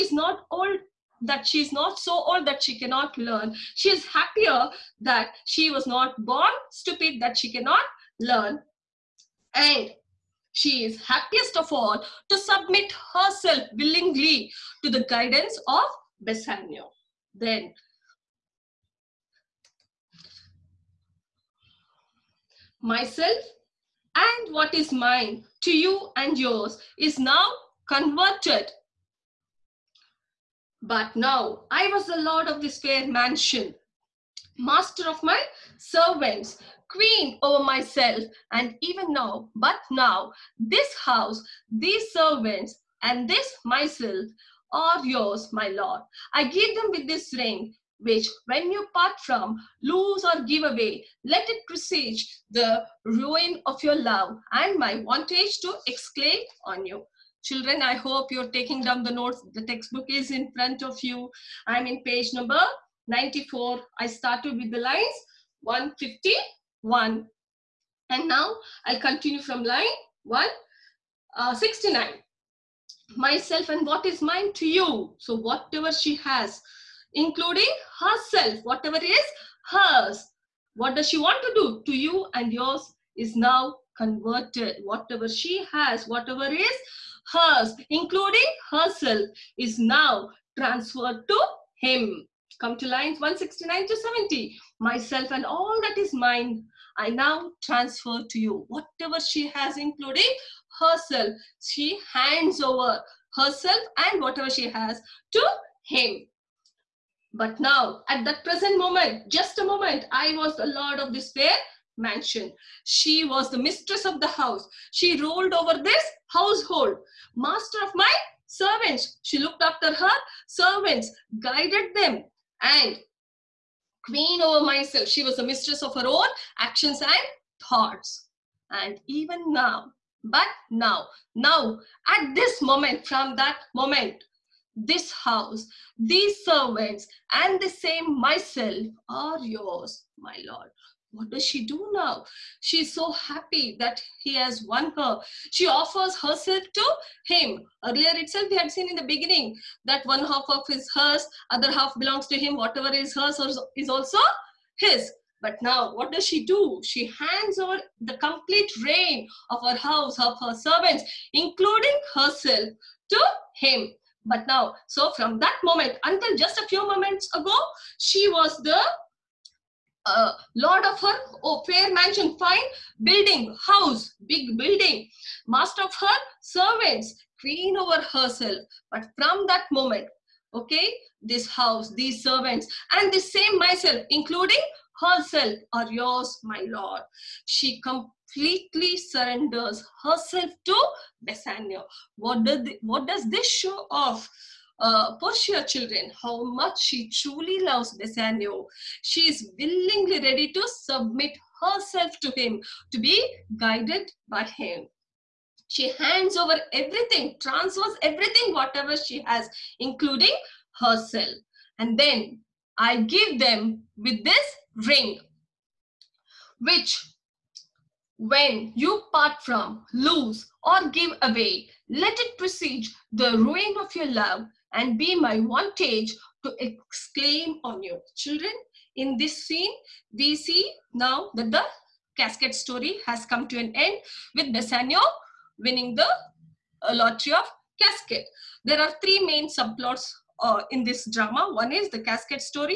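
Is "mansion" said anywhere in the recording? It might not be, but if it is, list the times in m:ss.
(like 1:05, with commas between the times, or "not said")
0:33, 1:51, 2:51.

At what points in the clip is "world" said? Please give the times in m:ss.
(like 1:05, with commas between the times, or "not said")
not said.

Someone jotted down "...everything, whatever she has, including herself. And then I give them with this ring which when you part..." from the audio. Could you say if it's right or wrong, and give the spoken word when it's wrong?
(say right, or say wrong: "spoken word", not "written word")
right.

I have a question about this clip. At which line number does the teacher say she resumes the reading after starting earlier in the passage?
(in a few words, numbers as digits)
169.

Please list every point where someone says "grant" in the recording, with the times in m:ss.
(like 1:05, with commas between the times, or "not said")
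not said.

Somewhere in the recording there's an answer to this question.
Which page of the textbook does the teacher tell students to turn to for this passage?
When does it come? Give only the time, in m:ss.
1:03.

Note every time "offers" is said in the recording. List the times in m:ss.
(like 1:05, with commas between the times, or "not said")
2:25.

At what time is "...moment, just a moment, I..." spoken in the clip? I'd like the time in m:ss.
1:48.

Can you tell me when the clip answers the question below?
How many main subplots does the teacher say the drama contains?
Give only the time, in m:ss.
3:59.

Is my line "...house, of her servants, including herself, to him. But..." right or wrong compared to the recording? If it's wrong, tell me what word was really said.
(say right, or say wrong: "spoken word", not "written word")
right.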